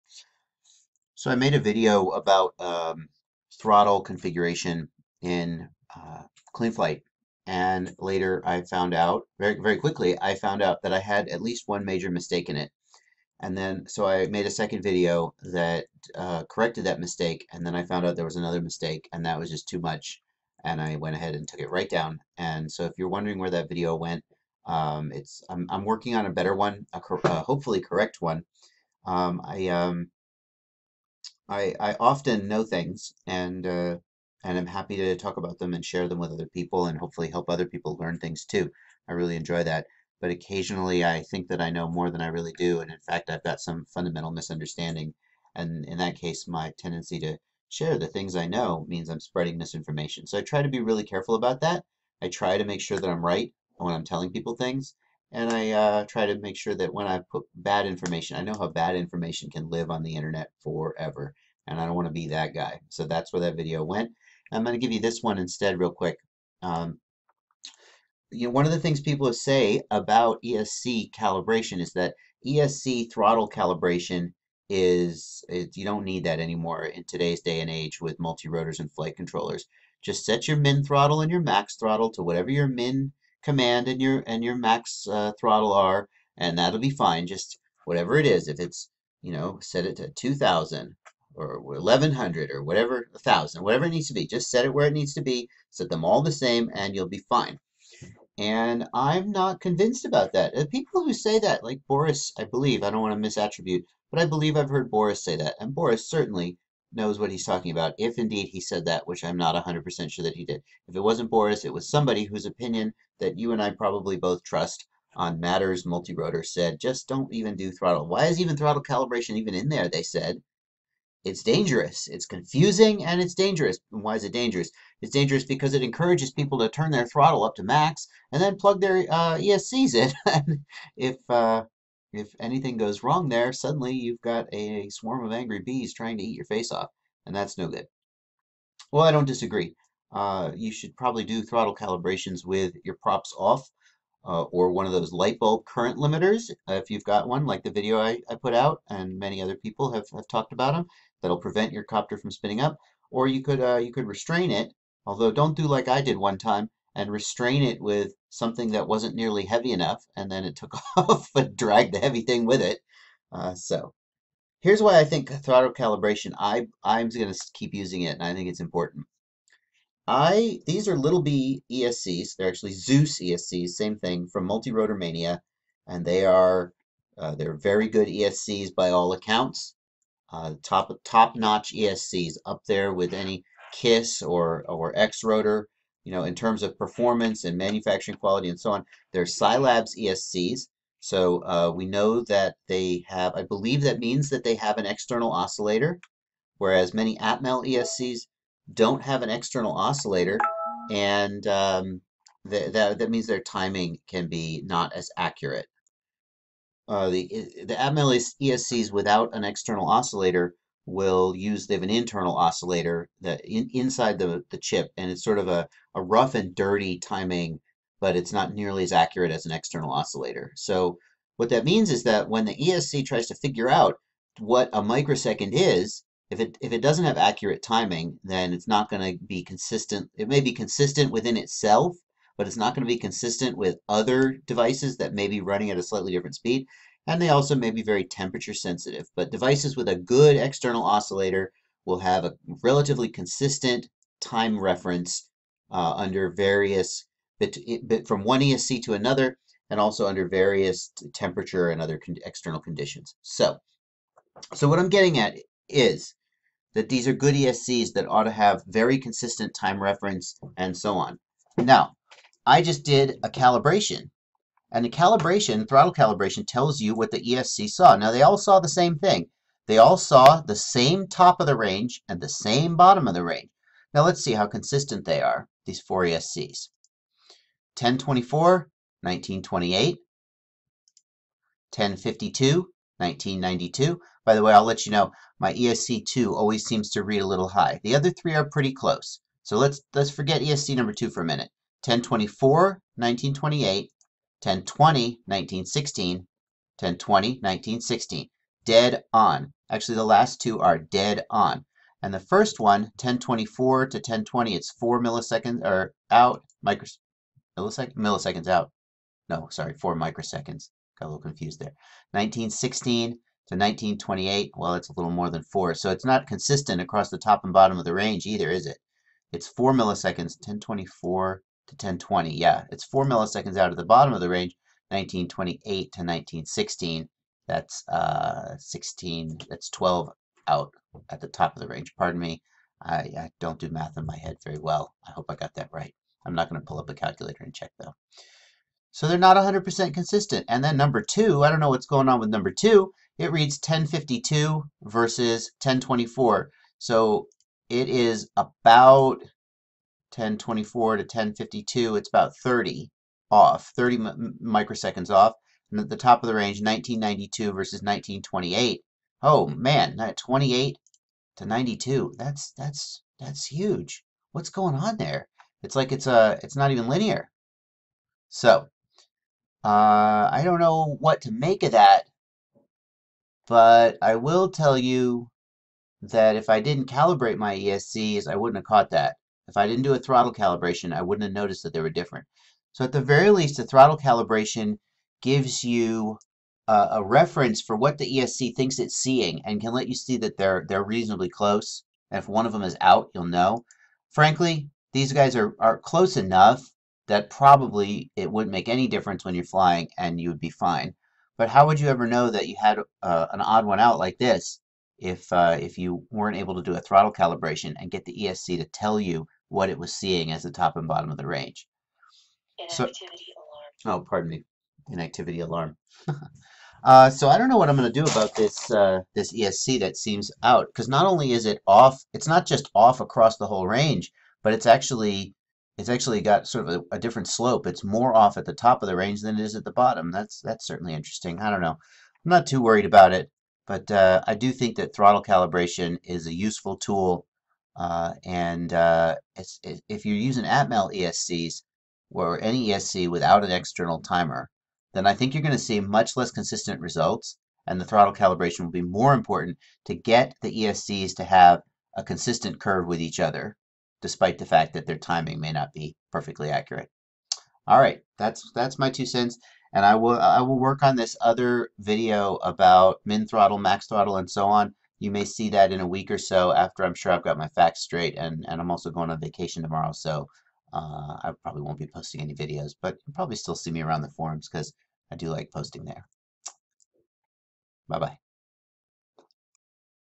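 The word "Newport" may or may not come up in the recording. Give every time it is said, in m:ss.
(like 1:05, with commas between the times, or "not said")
not said.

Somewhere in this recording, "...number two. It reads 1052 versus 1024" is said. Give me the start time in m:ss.
5:42.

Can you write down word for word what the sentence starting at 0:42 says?
And in fact, I've got some fundamental misunderstanding.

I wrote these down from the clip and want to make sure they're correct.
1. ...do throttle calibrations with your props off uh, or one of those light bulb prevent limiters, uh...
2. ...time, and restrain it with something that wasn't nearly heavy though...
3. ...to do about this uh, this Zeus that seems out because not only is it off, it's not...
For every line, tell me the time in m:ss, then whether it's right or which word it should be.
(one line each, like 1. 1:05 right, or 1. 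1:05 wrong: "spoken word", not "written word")
1. 2:21 wrong: "current", not "prevent"
2. 2:36 wrong: "enough", not "though"
3. 6:57 wrong: "ESC", not "Zeus".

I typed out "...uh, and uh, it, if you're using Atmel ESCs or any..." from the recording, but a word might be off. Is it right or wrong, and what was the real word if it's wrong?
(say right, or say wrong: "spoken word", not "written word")
right.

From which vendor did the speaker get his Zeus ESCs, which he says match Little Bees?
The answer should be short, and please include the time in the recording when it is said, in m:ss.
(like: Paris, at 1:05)
Multirotor Mania, at 2:54.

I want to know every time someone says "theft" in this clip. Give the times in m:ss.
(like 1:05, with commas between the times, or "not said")
not said.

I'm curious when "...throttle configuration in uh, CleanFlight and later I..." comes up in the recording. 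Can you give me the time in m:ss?
0:03.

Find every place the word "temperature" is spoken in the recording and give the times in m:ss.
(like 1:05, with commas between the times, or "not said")
3:58, 4:11.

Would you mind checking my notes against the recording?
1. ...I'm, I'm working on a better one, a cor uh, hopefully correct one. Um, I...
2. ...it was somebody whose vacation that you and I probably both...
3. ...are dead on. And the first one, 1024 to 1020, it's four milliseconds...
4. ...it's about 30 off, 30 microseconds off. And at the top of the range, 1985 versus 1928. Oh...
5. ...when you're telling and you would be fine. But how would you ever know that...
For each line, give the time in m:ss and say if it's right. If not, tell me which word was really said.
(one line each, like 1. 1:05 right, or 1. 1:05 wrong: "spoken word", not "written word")
1. 0:25 right
2. 1:51 wrong: "opinion", not "vacation"
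3. 5:00 right
4. 5:51 wrong: "1992", not "1985"
5. 6:39 wrong: "flying", not "telling".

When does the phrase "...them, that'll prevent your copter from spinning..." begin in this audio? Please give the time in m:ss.
2:30.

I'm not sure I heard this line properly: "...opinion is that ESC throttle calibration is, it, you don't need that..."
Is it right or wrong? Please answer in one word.
wrong.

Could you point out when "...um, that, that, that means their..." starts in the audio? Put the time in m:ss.
3:21.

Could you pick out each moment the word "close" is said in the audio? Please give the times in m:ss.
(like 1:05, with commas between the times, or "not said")
4:48, 6:31, 6:35.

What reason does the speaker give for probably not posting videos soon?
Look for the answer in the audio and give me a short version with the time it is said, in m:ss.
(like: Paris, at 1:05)
going on vacation, at 7:48.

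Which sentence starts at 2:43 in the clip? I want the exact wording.
Uh, so here's why I think throttle calibration, I, I'm going to keep using it, and I think it's important.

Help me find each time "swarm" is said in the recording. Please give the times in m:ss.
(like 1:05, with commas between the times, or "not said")
2:14.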